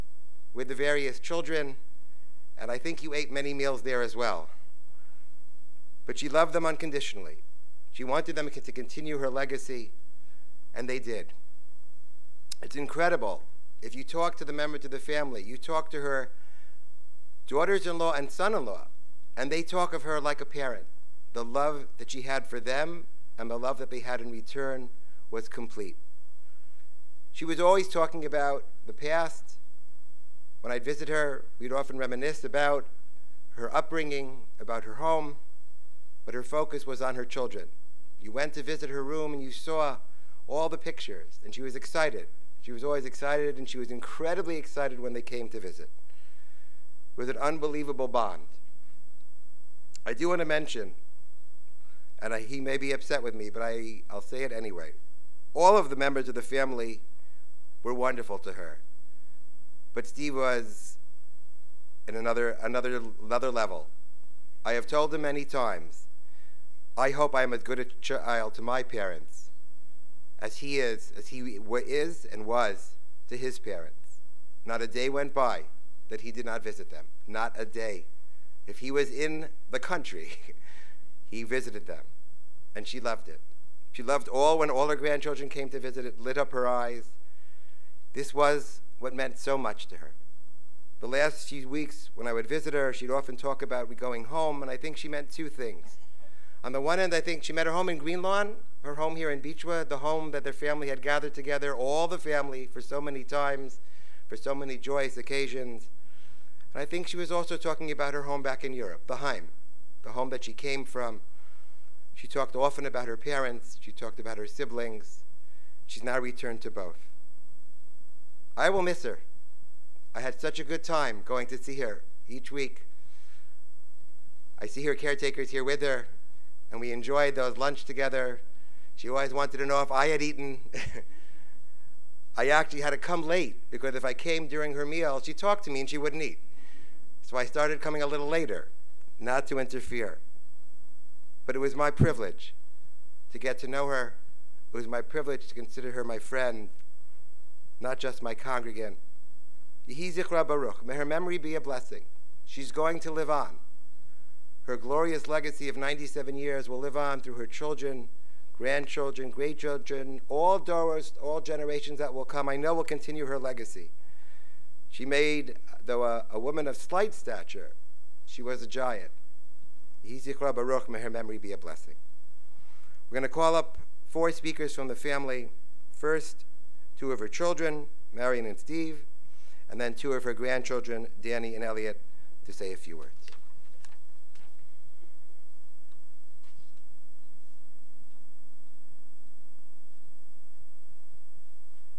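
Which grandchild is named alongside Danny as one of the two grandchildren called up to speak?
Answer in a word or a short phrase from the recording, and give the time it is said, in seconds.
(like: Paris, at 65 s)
Elliot, at 181 s.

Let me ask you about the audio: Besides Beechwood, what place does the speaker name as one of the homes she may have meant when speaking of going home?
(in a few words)
Green Lawn.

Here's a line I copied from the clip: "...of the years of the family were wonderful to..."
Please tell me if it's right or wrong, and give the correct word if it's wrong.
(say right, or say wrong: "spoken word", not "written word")
wrong: "members", not "years".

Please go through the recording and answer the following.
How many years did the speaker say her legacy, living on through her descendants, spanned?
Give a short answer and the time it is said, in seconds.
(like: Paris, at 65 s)
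97, at 155 s.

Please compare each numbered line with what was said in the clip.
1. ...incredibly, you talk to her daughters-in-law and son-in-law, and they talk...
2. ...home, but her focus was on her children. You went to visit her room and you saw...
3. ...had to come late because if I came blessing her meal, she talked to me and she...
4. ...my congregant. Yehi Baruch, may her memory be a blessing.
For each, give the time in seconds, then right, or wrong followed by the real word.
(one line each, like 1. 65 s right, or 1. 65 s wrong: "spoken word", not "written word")
1. 14 s wrong: "family", not "incredibly"
2. 34 s right
3. 132 s wrong: "during", not "blessing"
4. 148 s right.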